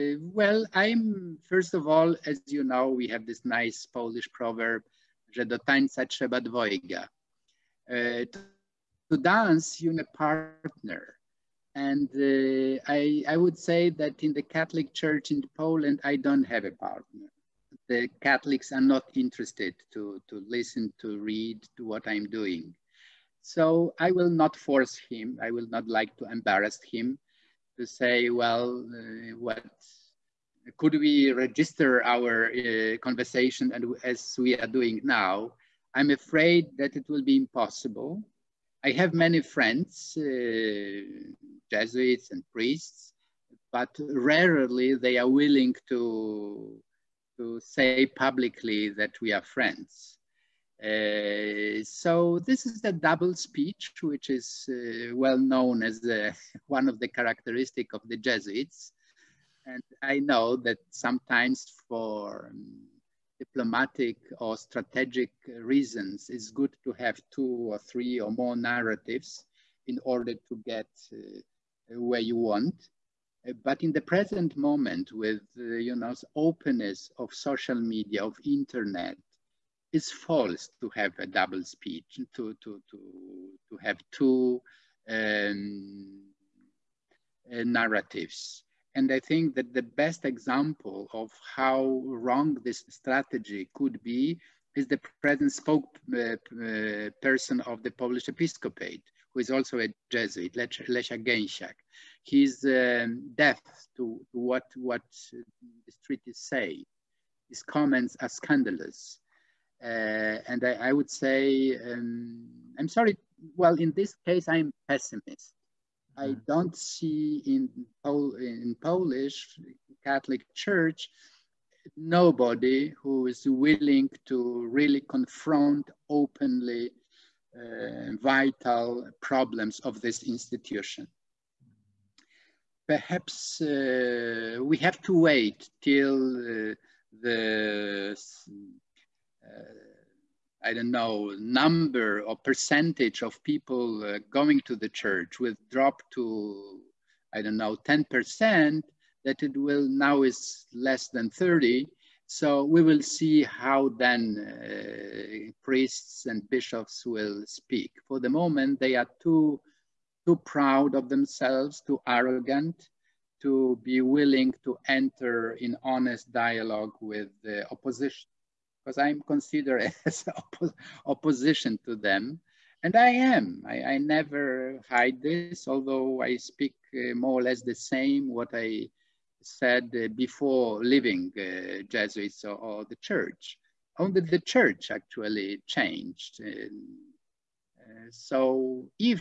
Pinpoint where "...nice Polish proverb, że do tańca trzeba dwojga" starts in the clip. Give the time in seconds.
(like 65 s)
3 s.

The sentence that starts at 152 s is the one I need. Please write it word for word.
So we will see how then uh, priests and bishops will speak.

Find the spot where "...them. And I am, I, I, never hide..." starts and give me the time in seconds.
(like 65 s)
171 s.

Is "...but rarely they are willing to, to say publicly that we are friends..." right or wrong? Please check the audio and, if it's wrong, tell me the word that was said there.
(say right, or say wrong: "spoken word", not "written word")
right.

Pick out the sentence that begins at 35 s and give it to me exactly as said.
I'm afraid that it will be impossible.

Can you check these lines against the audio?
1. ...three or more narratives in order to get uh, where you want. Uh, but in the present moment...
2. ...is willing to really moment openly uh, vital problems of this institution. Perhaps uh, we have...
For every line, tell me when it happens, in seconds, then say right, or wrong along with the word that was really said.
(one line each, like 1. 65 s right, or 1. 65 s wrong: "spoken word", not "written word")
1. 67 s right
2. 123 s wrong: "confront", not "moment".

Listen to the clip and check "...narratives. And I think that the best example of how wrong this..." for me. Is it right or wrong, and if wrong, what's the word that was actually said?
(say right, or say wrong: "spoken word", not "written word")
right.